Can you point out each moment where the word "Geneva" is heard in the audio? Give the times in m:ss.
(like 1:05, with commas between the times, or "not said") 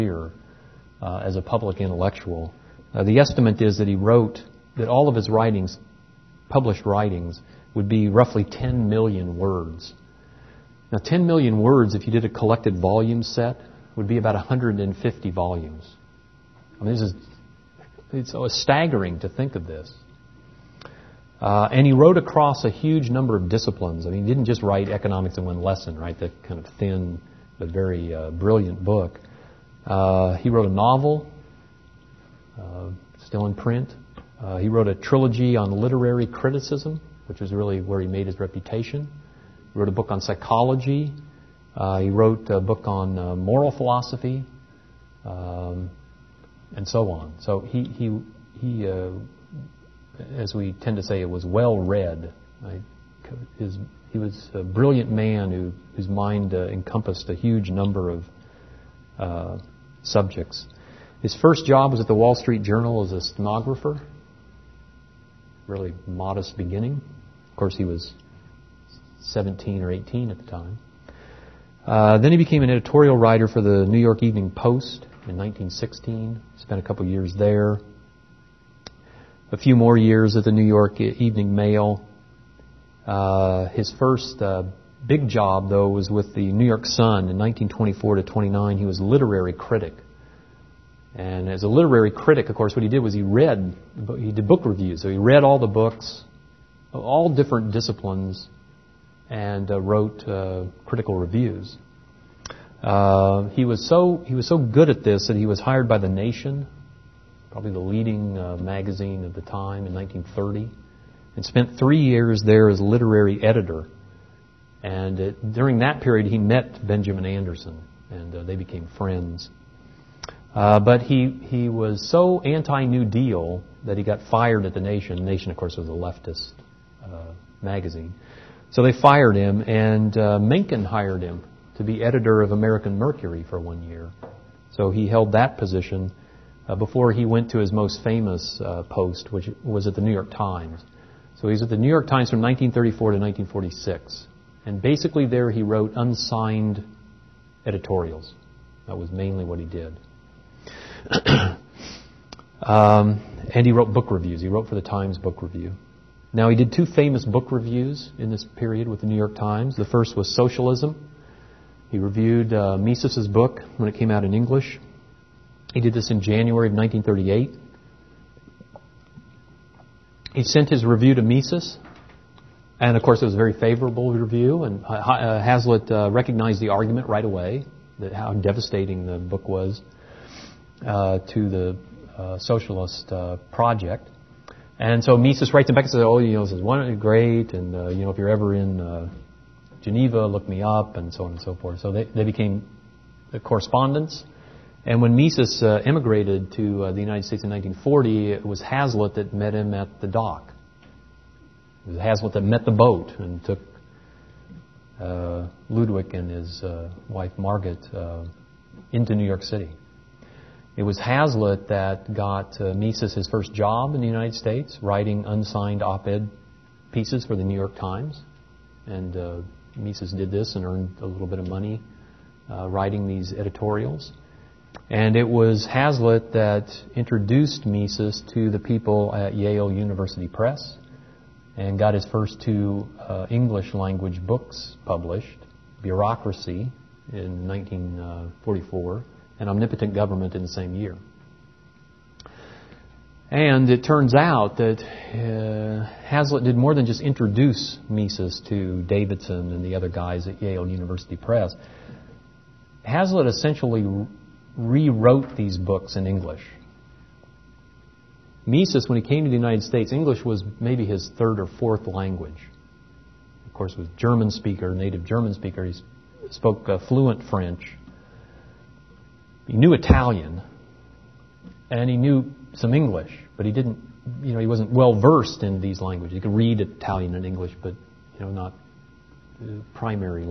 3:09.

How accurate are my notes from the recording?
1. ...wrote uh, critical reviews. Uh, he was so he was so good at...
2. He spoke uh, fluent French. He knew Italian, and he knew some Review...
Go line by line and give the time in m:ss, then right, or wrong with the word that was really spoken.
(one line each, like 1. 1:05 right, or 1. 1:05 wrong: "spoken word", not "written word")
1. 1:39 right
2. 4:25 wrong: "English", not "Review".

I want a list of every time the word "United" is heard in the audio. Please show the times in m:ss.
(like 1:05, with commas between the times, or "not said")
3:16, 3:34, 4:19.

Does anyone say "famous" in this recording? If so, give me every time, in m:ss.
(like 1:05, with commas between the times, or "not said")
2:18, 2:36.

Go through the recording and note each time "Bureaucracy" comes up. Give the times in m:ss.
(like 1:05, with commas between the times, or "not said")
3:55.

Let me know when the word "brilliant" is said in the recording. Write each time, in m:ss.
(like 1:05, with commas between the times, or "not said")
0:28, 0:54.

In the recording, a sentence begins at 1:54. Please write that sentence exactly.
And uh, during that period, he met Benjamin Anderson, and uh, they became friends.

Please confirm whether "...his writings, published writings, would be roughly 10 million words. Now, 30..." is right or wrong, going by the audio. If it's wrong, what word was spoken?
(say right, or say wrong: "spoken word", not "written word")
wrong: "10", not "30".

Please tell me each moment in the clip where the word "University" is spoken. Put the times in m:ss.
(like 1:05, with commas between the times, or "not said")
3:49, 4:10.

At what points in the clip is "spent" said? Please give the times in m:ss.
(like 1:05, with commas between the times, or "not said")
1:16, 1:51.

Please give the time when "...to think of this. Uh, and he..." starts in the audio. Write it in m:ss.
0:19.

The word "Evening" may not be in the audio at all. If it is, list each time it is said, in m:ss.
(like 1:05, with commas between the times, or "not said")
1:14, 1:20.